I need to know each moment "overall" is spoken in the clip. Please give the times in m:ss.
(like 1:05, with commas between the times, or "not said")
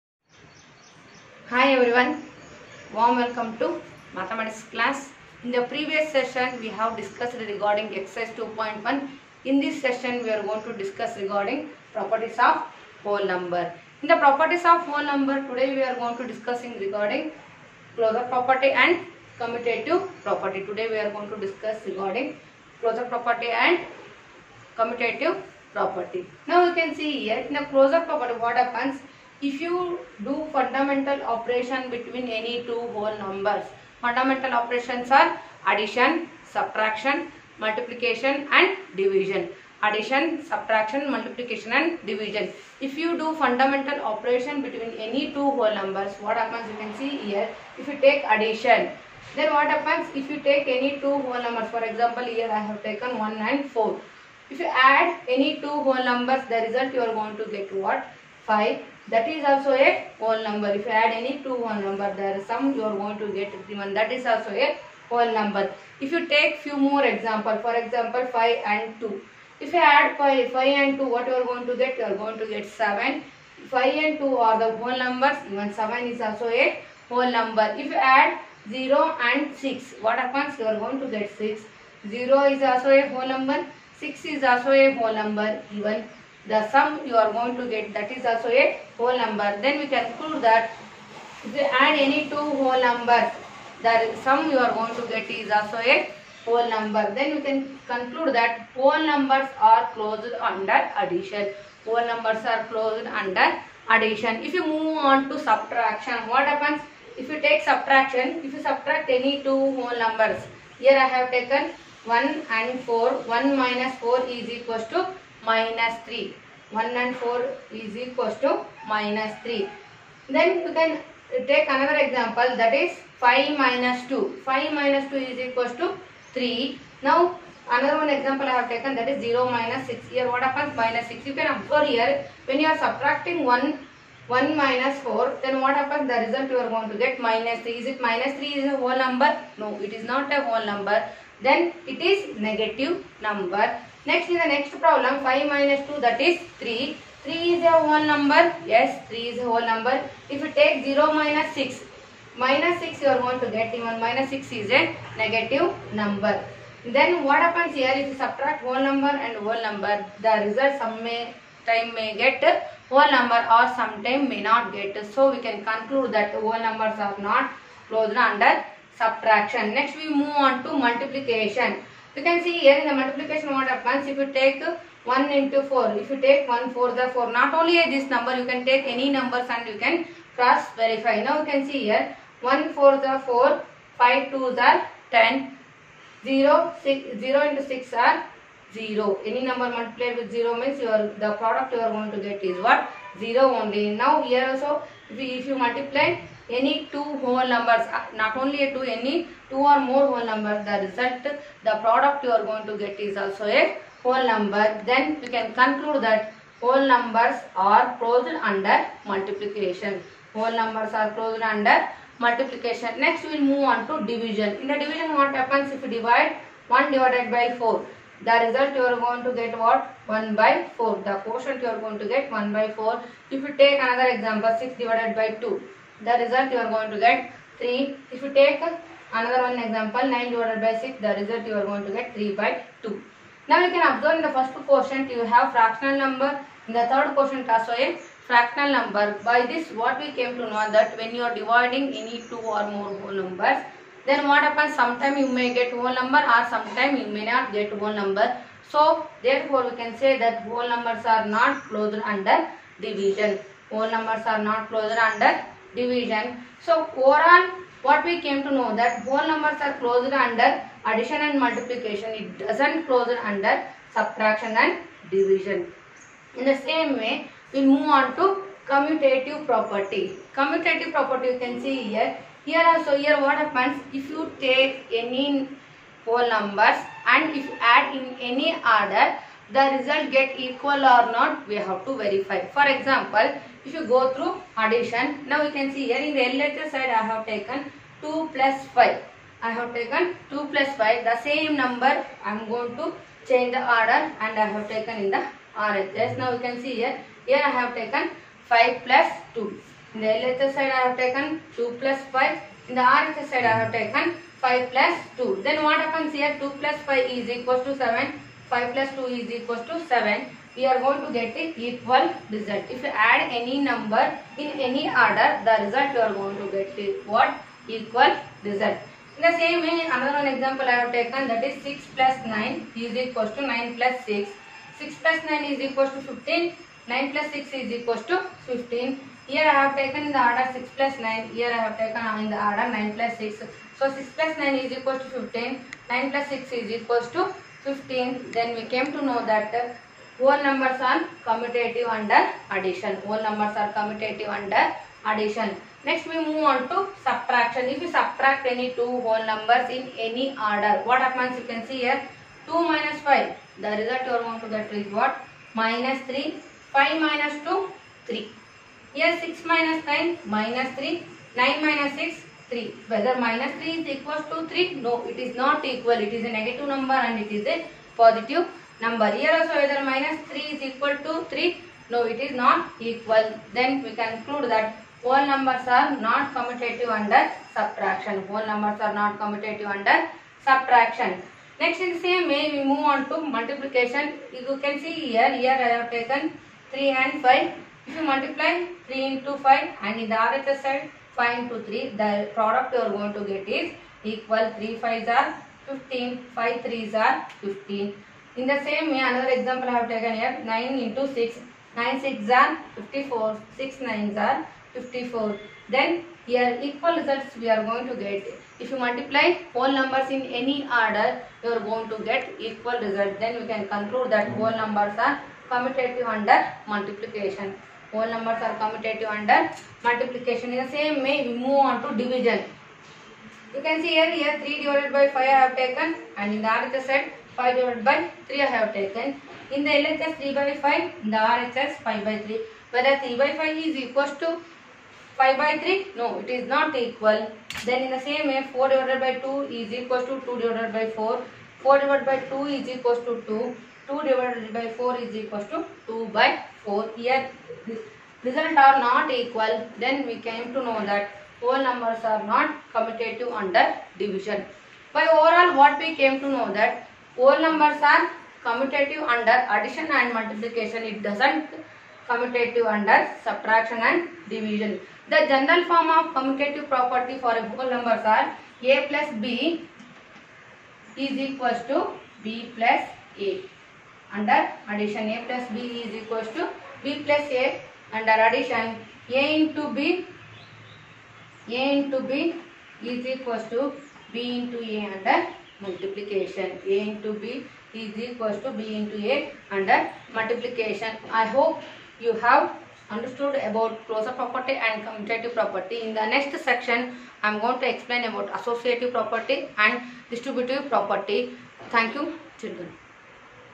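4:16, 7:35.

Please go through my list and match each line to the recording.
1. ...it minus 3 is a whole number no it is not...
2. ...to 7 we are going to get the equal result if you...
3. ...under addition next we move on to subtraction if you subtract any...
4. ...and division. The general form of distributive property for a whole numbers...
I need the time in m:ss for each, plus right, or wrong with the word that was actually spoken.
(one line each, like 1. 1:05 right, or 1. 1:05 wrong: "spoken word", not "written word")
1. 2:17 right
2. 5:09 right
3. 5:44 right
4. 7:43 wrong: "commutative", not "distributive".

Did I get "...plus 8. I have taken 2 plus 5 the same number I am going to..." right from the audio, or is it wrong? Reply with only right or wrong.
wrong.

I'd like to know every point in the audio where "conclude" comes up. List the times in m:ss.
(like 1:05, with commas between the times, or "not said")
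1:29, 1:37, 2:45, 3:25, 6:14, 6:53.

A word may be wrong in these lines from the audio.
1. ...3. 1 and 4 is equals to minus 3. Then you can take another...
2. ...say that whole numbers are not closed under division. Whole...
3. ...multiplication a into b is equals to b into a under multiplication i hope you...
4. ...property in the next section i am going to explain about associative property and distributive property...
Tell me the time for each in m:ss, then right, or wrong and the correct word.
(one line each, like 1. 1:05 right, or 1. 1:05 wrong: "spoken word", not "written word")
1. 1:56 right
2. 4:09 right
3. 8:05 right
4. 8:15 right.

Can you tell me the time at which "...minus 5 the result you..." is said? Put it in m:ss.
5:52.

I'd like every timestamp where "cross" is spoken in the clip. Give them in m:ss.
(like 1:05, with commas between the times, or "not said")
3:00.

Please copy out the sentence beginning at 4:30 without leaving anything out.
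Commutative property you can see here.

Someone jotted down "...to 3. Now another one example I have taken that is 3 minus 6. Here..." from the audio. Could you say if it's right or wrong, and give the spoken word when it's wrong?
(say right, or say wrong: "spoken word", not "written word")
wrong: "0", not "3".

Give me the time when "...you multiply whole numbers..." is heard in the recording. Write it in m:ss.
6:48.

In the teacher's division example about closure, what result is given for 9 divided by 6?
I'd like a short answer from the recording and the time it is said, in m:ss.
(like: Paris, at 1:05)
3/2, at 3:52.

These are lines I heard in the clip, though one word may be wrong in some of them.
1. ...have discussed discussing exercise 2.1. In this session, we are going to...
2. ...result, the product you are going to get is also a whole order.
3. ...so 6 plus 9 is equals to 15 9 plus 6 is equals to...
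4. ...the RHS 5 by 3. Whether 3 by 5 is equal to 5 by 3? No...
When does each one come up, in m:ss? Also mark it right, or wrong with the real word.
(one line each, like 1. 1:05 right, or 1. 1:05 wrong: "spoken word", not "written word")
1. 0:06 wrong: "regarding", not "discussing"
2. 3:20 wrong: "number", not "order"
3. 5:33 right
4. 7:11 right.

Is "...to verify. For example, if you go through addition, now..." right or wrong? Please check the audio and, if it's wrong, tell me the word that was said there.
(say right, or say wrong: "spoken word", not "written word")
right.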